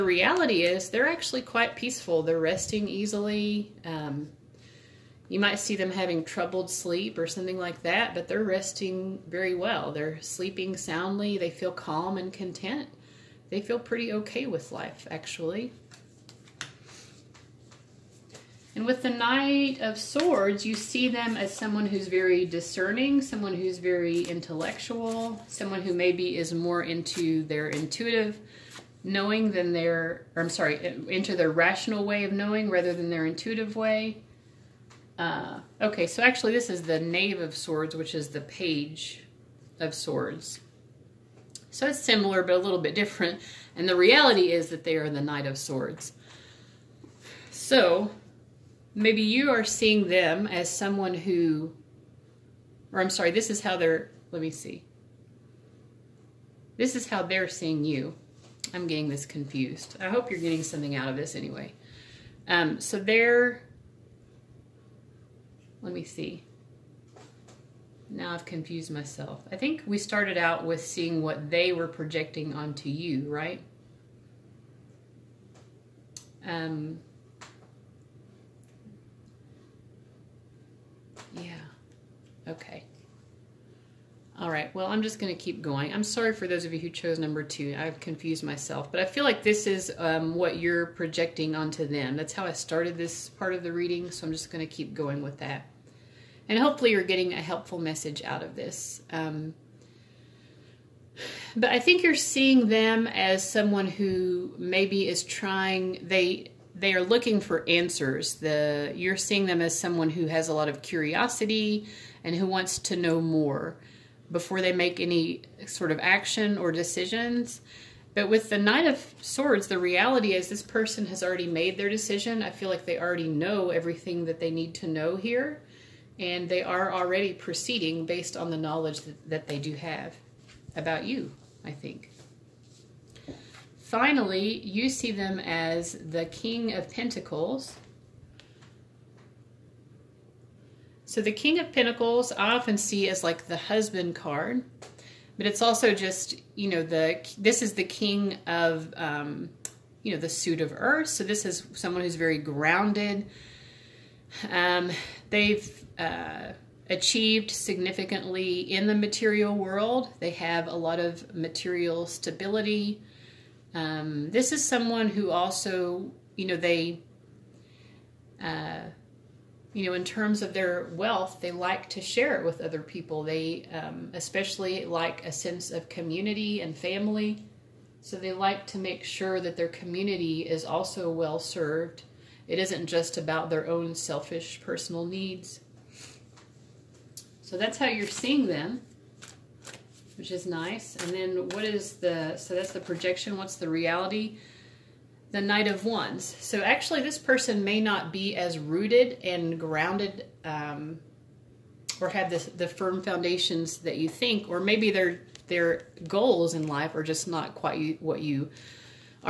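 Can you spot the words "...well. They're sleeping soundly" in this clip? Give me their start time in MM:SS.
00:09.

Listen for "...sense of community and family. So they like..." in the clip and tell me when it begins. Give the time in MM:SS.
02:55.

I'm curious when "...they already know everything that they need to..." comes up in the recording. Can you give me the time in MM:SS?
02:02.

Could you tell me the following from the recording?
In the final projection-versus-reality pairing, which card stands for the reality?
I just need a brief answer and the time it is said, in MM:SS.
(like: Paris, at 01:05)
Knight of Wands, at 03:15.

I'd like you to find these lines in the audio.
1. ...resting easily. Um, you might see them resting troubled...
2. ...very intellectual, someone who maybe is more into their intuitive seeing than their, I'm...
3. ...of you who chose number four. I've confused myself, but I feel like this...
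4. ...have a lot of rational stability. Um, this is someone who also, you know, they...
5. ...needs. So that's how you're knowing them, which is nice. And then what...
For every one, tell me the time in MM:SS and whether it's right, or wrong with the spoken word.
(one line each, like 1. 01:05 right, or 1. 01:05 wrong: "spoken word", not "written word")
1. 00:02 wrong: "having", not "resting"
2. 00:23 wrong: "knowing", not "seeing"
3. 01:26 wrong: "two", not "four"
4. 02:40 wrong: "material", not "rational"
5. 03:05 wrong: "seeing", not "knowing".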